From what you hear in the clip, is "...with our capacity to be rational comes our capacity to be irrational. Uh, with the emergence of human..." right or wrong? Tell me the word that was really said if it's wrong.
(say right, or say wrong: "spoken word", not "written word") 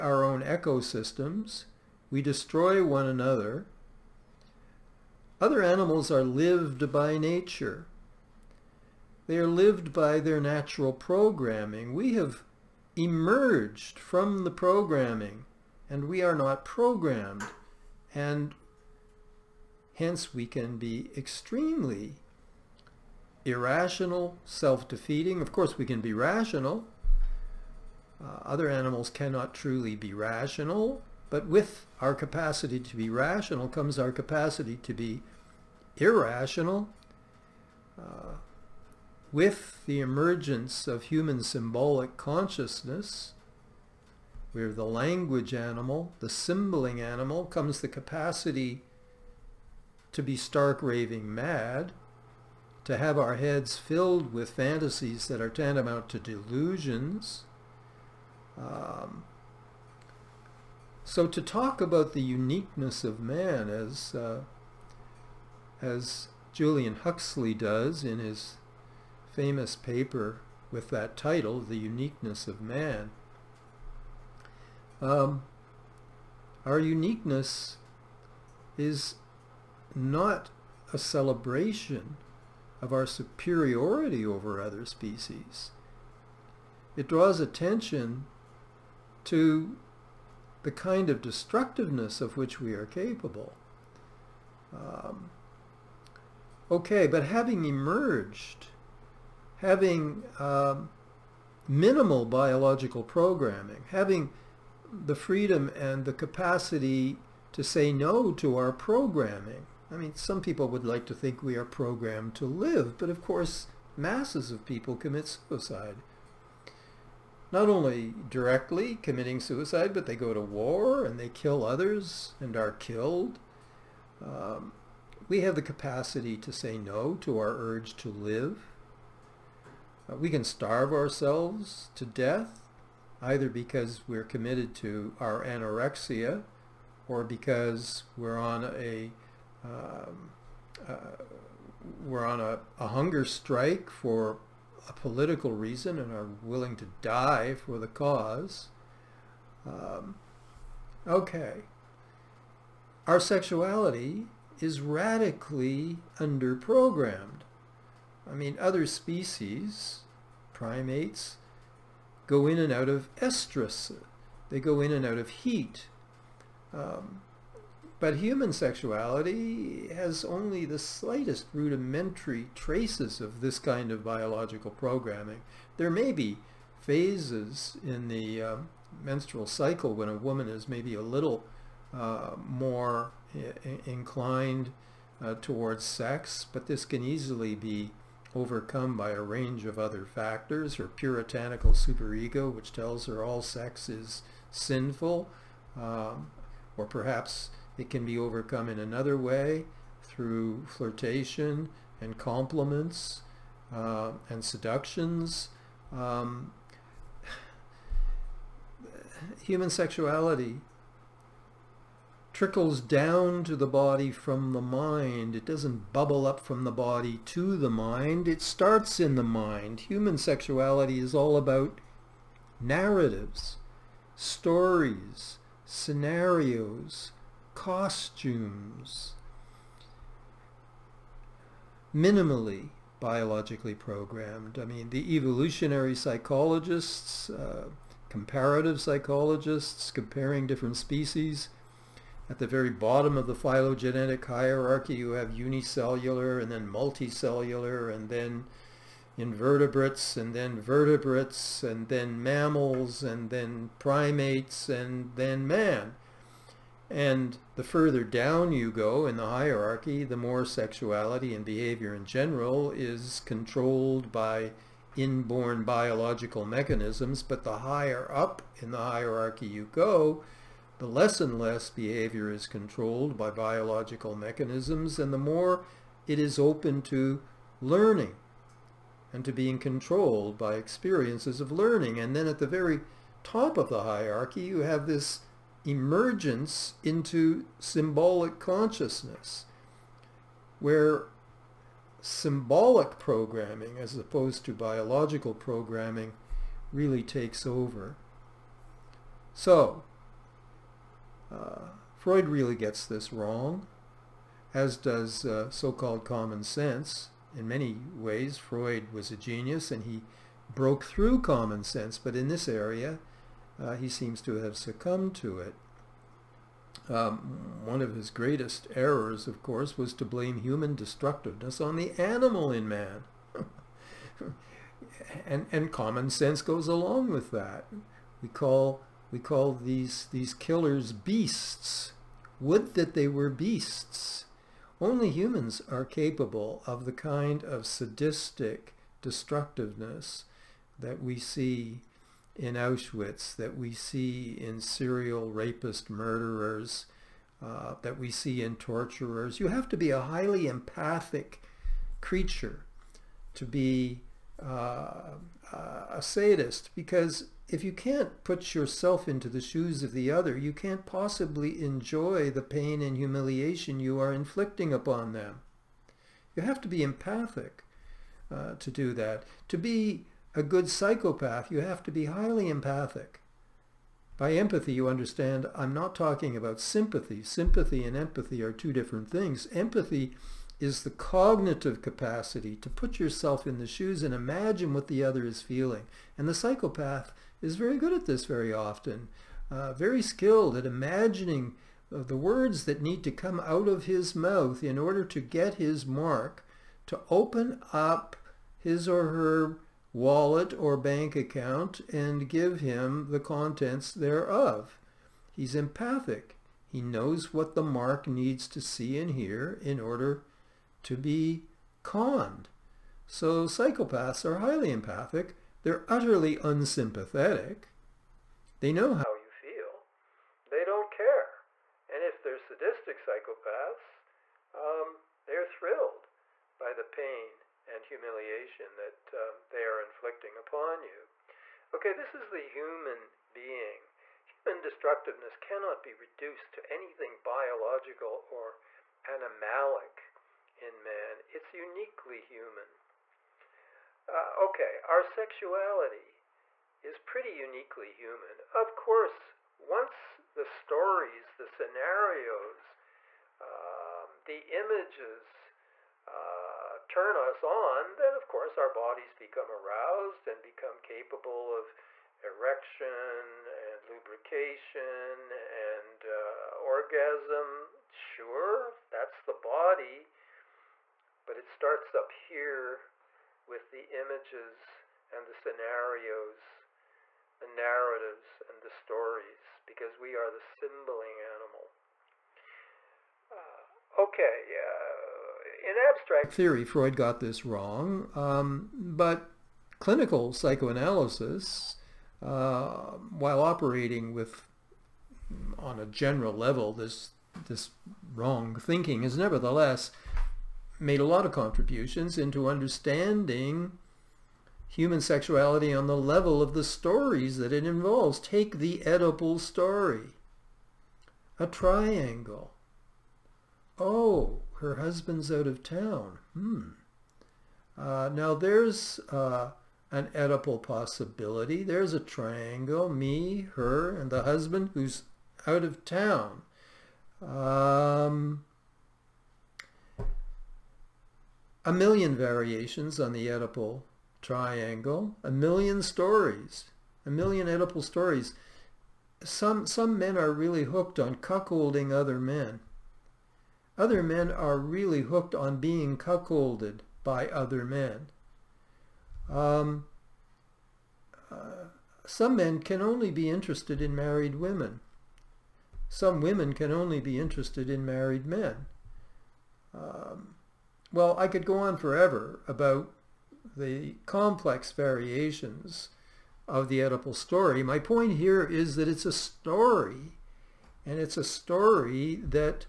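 right.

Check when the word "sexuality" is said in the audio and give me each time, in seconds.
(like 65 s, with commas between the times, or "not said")
153 s, 168 s, 209 s, 220 s, 260 s, 445 s, 504 s.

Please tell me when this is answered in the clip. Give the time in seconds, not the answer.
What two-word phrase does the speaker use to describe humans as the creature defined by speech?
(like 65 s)
44 s.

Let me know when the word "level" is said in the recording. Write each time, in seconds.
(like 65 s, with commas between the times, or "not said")
496 s, 505 s.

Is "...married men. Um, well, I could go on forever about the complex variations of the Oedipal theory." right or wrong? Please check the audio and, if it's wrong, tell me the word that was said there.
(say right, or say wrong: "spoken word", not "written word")
wrong: "story", not "theory".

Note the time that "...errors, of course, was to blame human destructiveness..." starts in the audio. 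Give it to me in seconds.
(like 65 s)
318 s.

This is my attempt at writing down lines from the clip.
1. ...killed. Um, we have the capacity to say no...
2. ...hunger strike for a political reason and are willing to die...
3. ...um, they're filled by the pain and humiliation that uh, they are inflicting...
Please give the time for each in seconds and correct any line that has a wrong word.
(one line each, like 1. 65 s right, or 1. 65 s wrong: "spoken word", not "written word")
1. 122 s right
2. 142 s right
3. 424 s wrong: "thrilled", not "filled".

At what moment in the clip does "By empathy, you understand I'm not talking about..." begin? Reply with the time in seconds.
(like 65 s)
374 s.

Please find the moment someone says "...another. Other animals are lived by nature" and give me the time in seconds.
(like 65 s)
3 s.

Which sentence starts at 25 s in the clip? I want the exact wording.
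Of course, we can be rational.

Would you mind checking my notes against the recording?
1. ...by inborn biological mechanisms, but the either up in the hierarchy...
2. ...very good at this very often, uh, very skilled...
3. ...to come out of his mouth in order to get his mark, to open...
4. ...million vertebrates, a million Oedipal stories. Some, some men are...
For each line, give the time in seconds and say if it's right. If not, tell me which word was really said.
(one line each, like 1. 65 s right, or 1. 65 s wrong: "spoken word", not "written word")
1. 264 s wrong: "higher", not "either"
2. 387 s right
3. 393 s right
4. 535 s wrong: "stories", not "vertebrates".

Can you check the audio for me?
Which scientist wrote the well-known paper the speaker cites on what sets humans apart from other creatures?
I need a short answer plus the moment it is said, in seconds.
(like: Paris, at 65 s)
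Julian Huxley, at 66 s.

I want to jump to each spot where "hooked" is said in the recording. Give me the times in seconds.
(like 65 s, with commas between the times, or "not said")
540 s, 545 s.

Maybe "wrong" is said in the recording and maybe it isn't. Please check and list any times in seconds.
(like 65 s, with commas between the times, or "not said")
303 s, 487 s, 498 s.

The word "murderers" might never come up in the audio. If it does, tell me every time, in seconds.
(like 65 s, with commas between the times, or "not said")
345 s.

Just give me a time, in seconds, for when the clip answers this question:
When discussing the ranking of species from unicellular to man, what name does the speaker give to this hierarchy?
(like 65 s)
243 s.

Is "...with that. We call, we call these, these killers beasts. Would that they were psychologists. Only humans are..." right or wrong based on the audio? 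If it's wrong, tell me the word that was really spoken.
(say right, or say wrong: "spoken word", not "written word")
wrong: "beasts", not "psychologists".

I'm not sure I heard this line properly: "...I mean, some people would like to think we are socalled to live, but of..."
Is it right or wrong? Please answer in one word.
wrong.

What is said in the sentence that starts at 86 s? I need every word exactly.
It draws attention to the kind of destructiveness of which we are capable.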